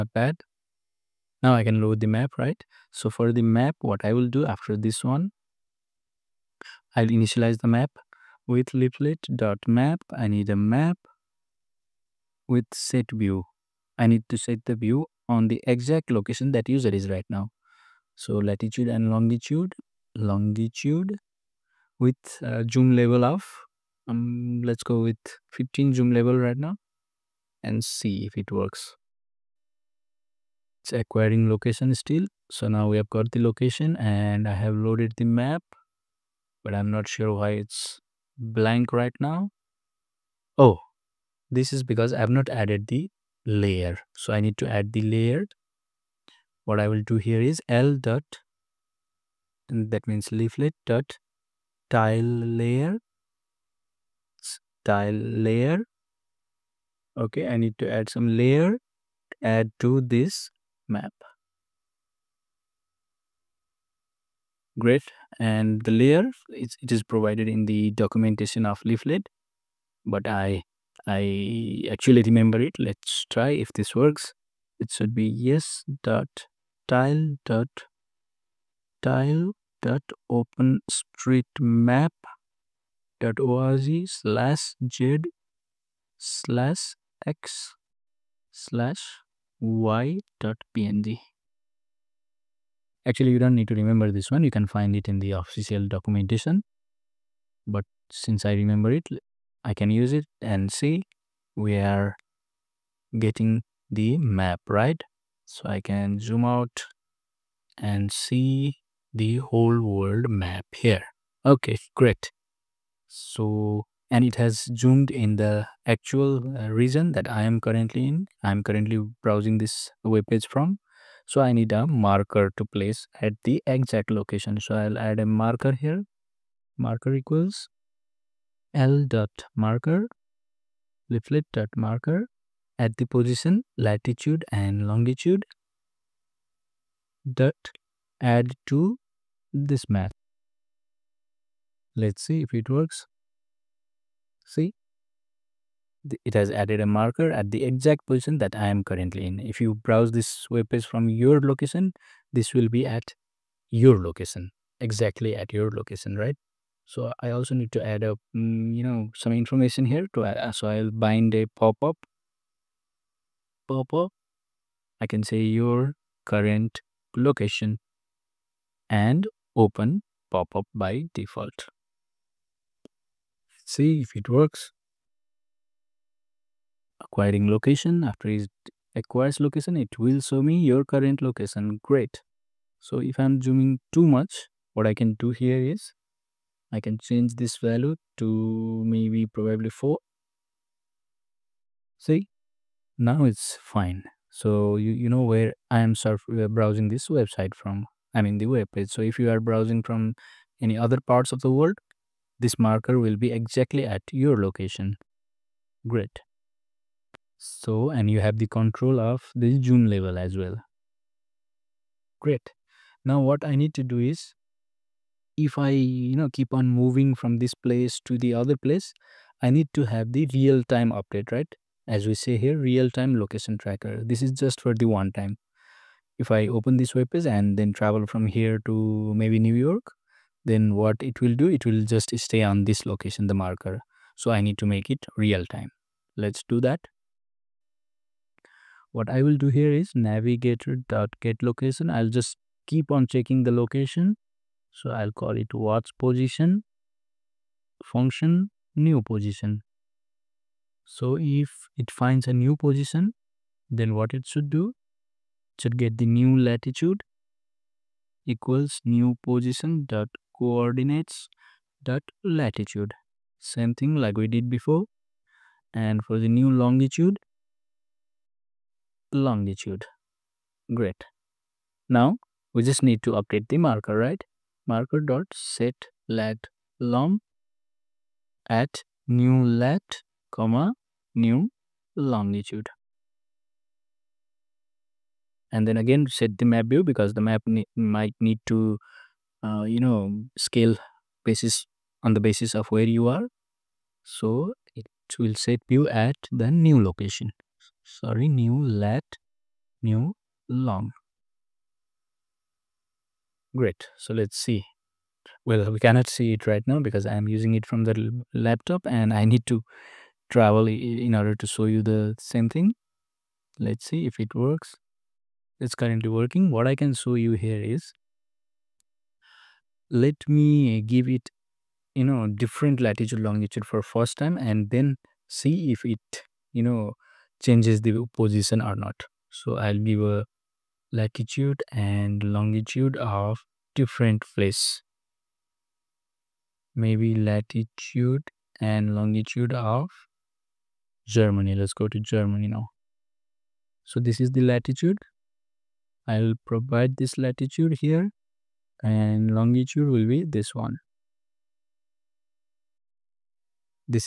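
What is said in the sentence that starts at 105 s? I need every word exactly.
So I can zoom out and see the whole world map here.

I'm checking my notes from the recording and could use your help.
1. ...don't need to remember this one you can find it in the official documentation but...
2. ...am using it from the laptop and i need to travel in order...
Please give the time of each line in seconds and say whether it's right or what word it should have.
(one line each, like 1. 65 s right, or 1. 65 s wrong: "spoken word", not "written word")
1. 93 s right
2. 307 s right.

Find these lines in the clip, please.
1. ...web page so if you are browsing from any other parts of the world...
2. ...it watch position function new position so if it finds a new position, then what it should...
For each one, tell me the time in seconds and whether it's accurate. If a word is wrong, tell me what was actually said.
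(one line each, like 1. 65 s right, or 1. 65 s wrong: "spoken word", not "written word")
1. 198 s right
2. 245 s right.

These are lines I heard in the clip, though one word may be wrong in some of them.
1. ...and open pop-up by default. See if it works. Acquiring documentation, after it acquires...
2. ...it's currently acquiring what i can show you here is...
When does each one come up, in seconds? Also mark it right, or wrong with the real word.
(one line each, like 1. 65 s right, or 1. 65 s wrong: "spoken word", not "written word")
1. 168 s wrong: "location", not "documentation"
2. 315 s wrong: "working", not "acquiring".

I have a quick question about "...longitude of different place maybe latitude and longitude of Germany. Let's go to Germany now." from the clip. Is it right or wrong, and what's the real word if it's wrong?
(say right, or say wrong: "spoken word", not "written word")
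right.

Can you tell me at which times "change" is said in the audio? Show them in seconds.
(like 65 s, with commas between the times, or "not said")
187 s, 327 s.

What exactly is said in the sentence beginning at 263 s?
Same thing like we did before.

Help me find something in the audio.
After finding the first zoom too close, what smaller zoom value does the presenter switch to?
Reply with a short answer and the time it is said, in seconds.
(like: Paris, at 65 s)
4, at 189 s.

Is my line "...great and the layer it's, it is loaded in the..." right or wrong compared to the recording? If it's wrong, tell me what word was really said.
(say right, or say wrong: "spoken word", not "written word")
wrong: "provided", not "loaded".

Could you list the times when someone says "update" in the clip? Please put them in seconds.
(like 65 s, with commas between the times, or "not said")
220 s, 273 s.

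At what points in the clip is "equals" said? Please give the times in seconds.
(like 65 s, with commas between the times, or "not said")
127 s, 258 s.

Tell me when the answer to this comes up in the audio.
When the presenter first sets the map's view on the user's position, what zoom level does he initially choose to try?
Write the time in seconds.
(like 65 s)
25 s.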